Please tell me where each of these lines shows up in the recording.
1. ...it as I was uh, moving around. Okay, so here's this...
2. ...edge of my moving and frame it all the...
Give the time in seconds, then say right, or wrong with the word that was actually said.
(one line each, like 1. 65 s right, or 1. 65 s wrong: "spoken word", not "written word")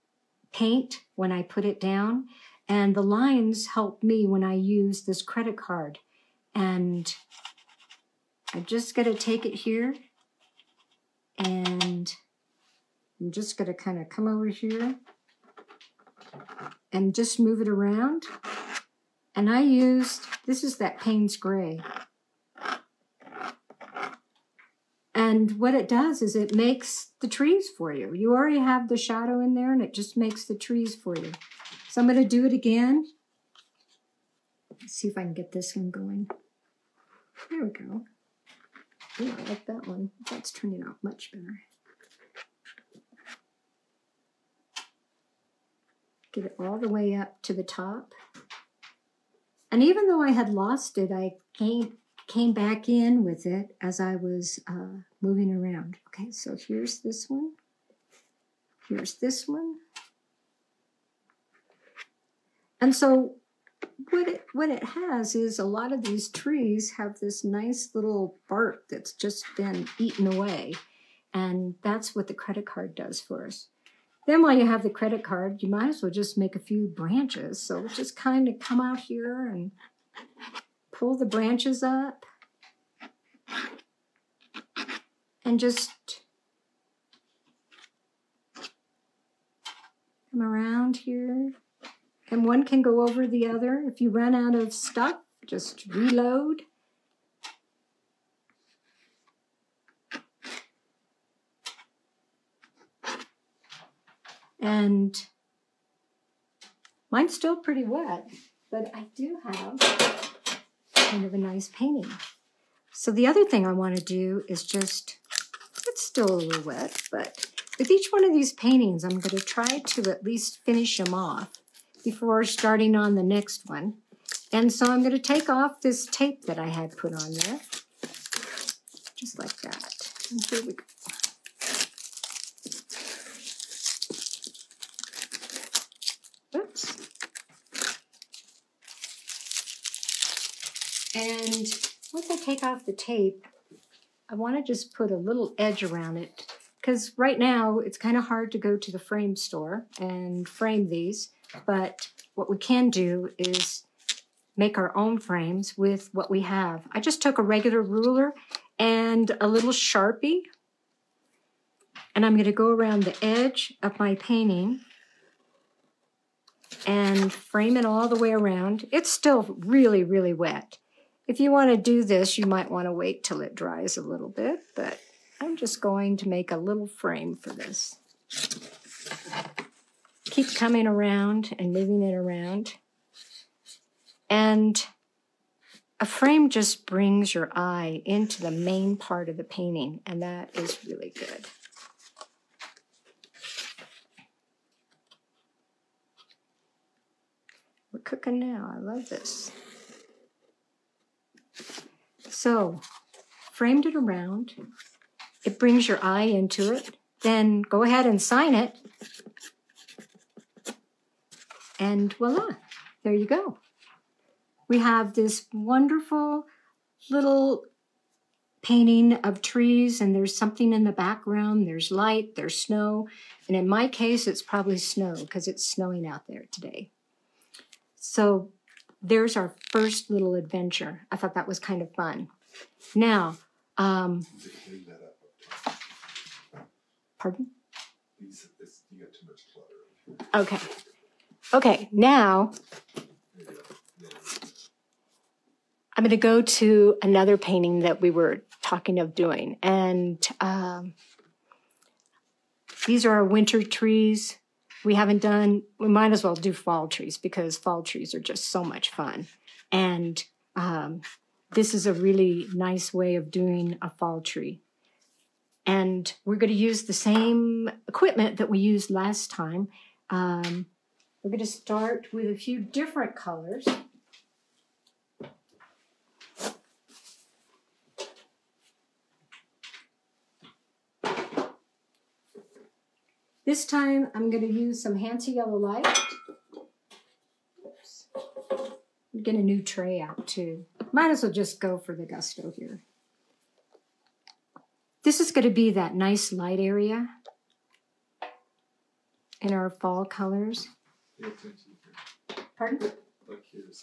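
1. 53 s right
2. 163 s wrong: "painting", not "moving".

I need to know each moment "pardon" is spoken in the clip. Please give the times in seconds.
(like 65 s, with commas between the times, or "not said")
237 s, 302 s.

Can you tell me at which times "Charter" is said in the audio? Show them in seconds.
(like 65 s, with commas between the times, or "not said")
not said.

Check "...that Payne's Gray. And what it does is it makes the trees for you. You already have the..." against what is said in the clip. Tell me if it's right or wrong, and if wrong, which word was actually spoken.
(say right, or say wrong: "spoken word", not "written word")
right.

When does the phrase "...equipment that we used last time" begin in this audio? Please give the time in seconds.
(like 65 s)
267 s.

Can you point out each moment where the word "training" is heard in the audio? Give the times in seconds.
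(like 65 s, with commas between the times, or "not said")
not said.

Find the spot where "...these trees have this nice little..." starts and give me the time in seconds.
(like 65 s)
66 s.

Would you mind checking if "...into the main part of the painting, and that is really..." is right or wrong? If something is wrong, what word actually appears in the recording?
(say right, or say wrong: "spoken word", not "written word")
right.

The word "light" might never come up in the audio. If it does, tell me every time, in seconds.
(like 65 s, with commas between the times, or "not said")
221 s, 285 s, 296 s.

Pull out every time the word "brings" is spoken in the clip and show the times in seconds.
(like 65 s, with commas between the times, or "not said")
186 s, 205 s.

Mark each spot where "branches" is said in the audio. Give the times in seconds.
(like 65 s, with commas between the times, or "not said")
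76 s, 81 s.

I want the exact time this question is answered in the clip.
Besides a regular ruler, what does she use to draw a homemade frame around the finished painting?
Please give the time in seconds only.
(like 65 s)
159 s.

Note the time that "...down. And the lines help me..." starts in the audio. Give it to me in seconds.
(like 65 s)
1 s.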